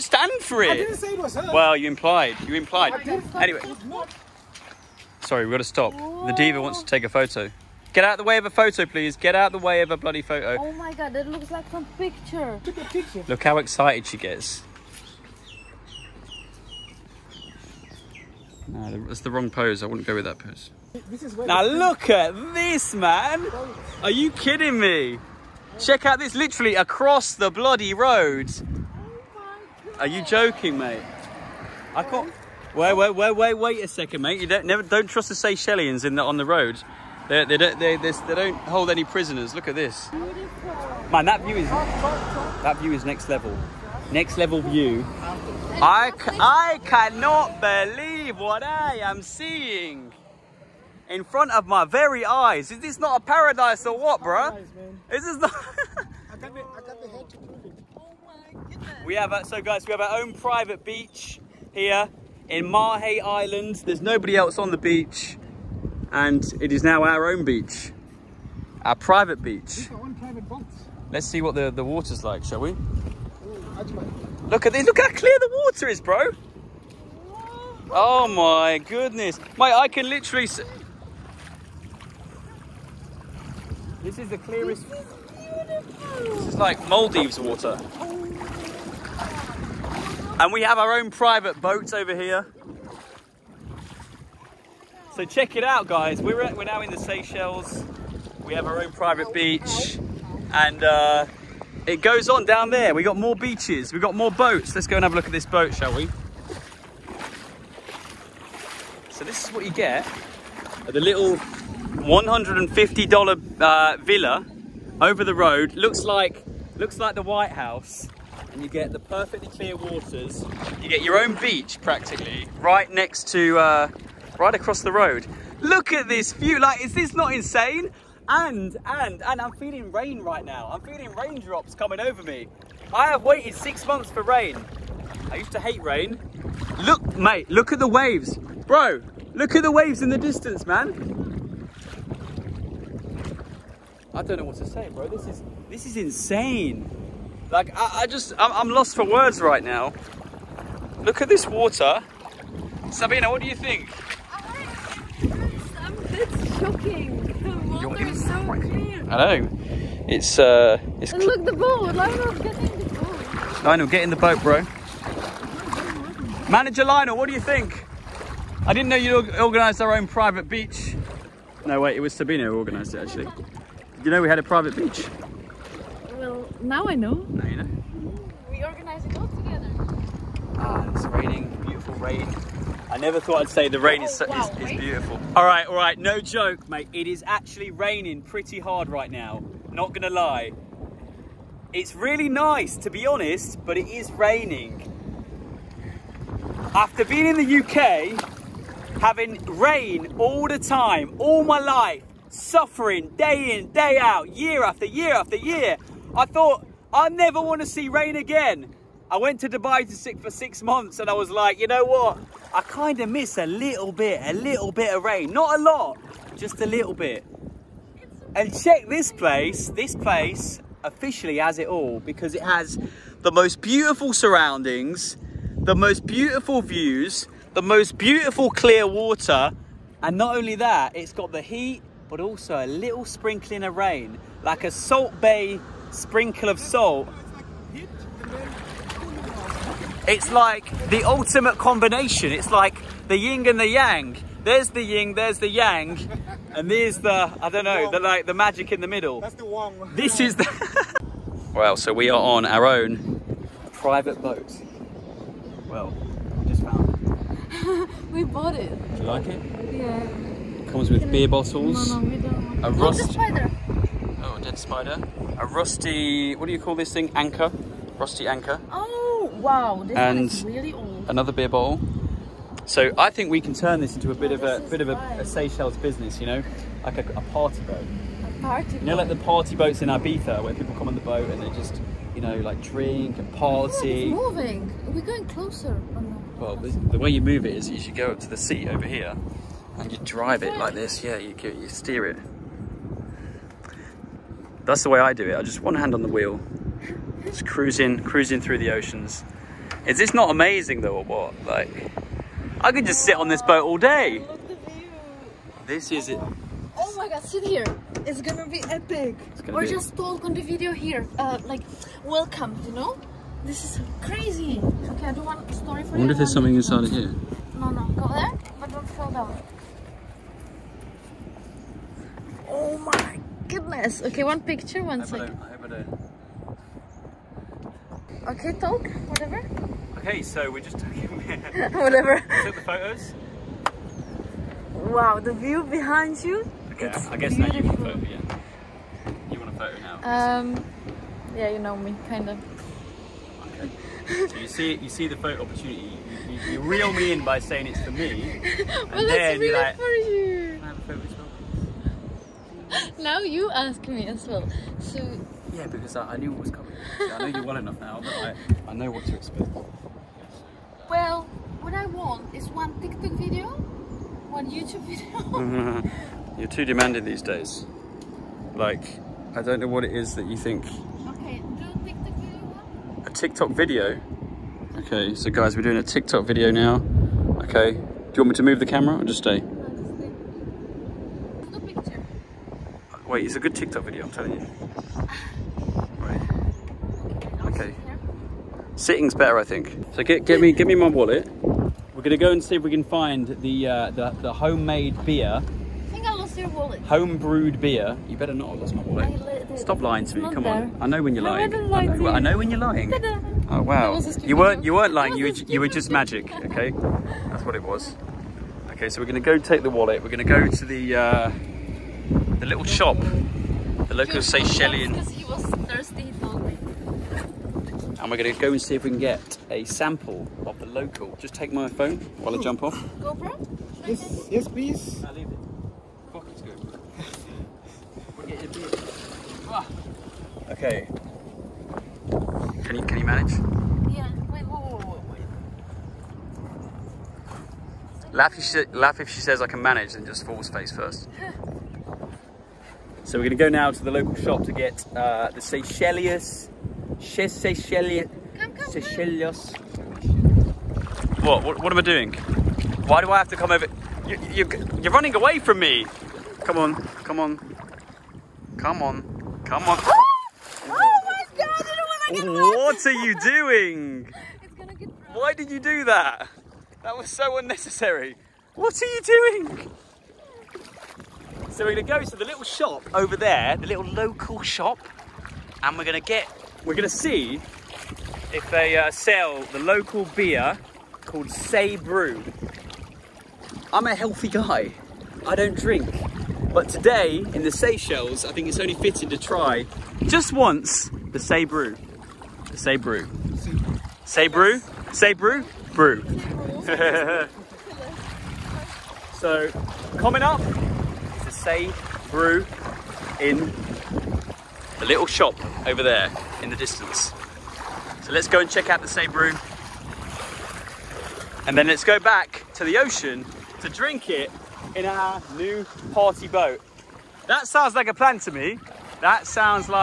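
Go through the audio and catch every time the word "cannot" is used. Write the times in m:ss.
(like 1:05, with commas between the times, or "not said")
0:46.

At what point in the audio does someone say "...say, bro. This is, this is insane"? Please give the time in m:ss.
2:24.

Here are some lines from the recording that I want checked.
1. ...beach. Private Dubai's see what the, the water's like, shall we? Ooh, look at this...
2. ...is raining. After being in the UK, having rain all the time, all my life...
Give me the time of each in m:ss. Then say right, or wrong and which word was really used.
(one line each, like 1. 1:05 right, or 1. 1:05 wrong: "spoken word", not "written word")
1. 1:09 wrong: "Let", not "Dubai"
2. 3:13 right.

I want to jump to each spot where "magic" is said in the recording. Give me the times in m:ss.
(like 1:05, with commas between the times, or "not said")
4:08, 6:45.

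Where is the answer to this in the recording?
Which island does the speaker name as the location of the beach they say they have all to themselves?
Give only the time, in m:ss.
1:02.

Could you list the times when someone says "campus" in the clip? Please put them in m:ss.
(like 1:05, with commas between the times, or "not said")
not said.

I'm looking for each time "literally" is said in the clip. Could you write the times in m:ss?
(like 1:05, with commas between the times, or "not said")
0:26, 1:20.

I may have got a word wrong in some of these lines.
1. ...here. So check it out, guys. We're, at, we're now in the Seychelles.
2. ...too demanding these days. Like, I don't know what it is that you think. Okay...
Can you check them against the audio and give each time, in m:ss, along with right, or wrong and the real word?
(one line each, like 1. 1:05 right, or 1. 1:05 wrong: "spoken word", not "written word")
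1. 1:32 right
2. 6:06 right.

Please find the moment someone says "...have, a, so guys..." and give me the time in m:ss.
0:59.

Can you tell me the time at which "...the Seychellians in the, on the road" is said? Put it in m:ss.
0:35.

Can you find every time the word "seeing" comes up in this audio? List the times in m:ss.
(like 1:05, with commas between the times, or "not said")
0:49.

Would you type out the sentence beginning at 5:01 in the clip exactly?
Like, I could just sit on this boat all day.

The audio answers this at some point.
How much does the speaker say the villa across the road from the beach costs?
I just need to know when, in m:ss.
1:51.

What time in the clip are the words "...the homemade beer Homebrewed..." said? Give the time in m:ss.
6:34.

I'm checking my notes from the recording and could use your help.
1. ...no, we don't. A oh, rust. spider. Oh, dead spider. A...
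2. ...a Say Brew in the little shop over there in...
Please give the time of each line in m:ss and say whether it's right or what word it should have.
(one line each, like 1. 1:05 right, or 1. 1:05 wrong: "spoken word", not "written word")
1. 4:22 right
2. 8:21 right.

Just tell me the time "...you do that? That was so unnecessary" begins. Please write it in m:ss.
7:45.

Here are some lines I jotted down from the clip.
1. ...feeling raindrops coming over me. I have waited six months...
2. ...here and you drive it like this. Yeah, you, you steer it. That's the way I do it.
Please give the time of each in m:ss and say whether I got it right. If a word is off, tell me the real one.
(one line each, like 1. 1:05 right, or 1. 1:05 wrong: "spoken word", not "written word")
1. 2:10 right
2. 4:48 right.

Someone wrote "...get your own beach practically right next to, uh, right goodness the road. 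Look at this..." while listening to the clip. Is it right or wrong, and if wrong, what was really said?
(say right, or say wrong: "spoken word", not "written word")
wrong: "across", not "goodness".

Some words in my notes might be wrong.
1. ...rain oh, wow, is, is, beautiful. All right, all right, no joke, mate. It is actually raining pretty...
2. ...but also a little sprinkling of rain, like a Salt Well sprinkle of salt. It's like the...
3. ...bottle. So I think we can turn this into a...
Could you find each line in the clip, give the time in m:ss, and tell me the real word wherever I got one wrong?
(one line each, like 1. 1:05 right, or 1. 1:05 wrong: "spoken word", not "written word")
1. 3:03 right
2. 3:52 wrong: "Bae", not "Well"
3. 4:31 right.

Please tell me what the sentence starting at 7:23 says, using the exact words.
so we're going to go now to the local shop to get uh, the Come Seychelles, Seychelles.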